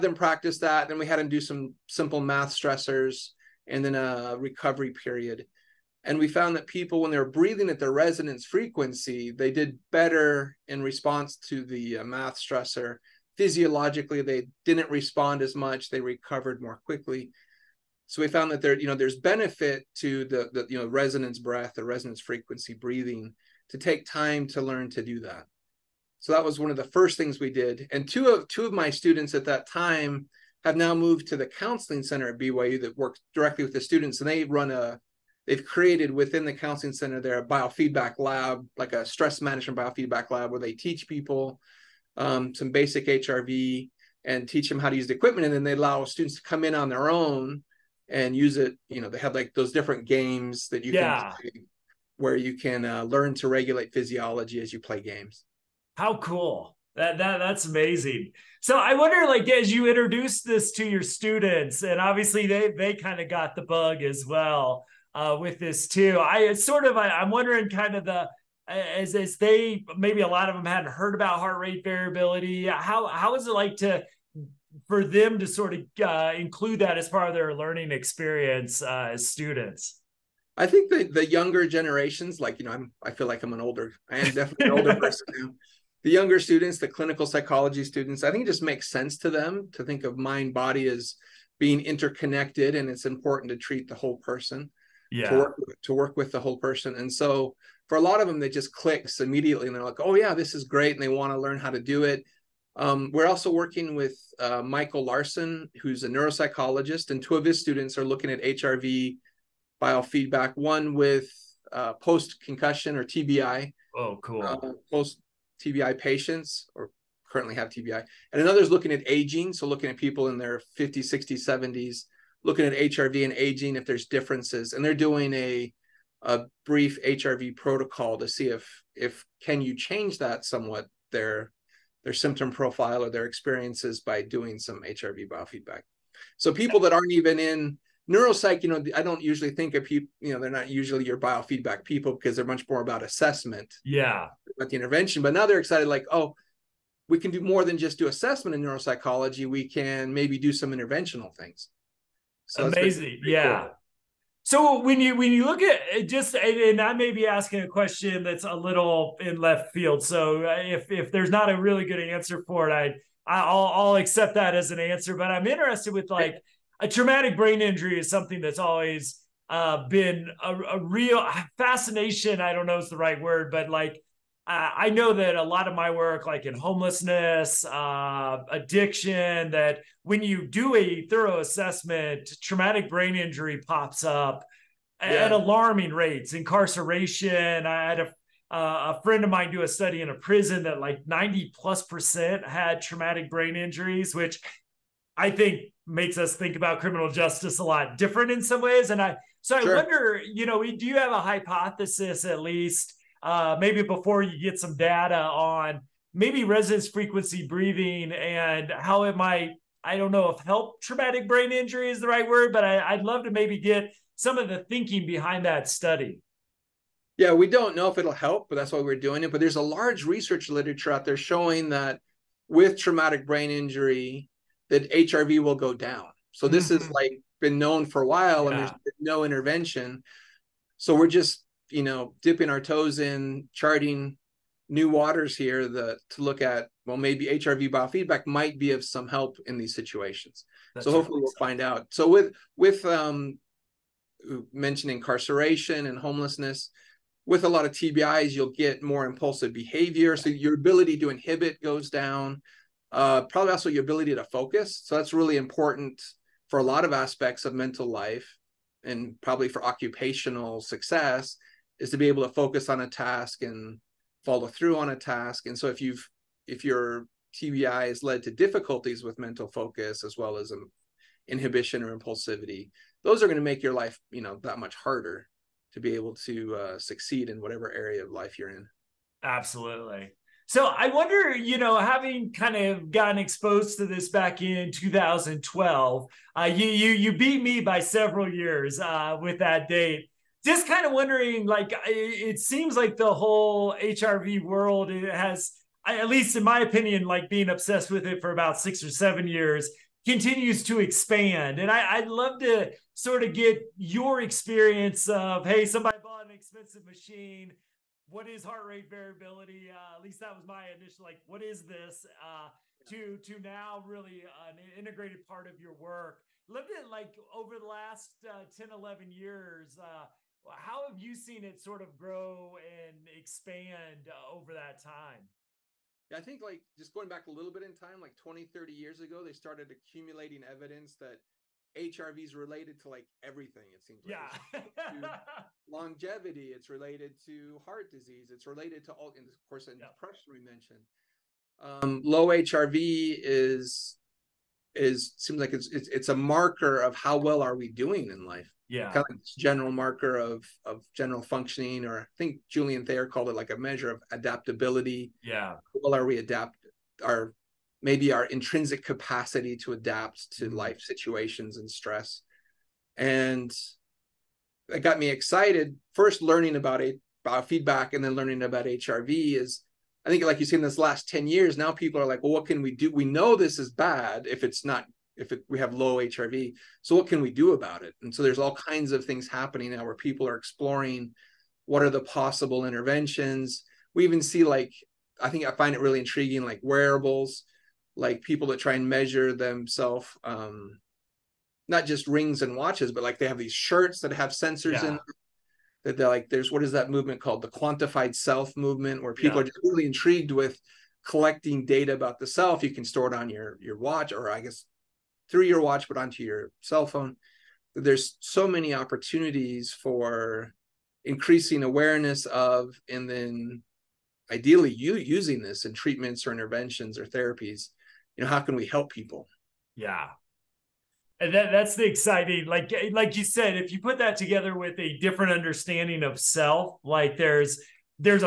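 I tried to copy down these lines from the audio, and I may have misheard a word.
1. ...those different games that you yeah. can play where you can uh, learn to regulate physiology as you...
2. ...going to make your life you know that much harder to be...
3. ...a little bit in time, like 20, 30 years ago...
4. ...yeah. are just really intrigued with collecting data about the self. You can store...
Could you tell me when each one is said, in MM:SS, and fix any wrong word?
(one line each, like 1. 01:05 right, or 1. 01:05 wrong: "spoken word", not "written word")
1. 00:49 right
2. 04:33 right
3. 05:27 right
4. 06:39 right.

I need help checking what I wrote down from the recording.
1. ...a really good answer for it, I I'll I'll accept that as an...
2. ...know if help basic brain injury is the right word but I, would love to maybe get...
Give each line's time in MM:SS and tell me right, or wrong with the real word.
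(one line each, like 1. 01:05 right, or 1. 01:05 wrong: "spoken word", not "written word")
1. 02:41 right
2. 03:30 wrong: "traumatic", not "basic".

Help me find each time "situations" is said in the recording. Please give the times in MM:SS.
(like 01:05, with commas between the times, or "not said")
03:59, 06:00.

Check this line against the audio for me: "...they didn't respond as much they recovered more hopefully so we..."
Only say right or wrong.
wrong.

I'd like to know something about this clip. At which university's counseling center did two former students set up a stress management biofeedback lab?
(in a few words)
BYU.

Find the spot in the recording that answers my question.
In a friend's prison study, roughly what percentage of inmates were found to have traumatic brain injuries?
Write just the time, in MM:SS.
03:11.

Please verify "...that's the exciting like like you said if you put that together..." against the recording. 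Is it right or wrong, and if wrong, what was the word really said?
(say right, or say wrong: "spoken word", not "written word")
right.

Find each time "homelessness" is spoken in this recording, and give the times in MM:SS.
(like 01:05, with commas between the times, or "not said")
02:56, 04:05.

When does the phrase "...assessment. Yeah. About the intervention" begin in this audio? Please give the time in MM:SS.
02:23.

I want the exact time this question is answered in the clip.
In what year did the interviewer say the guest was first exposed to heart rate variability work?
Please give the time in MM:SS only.
04:44.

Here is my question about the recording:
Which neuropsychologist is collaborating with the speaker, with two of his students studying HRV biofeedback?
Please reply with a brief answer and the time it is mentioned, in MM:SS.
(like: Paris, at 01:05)
Michael Larson, at 01:44.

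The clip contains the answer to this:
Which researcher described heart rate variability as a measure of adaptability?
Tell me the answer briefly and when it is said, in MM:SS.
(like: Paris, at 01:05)
Julian Thayer, at 05:52.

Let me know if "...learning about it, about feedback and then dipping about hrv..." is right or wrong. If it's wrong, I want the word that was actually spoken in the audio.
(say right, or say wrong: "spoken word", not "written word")
wrong: "learning", not "dipping".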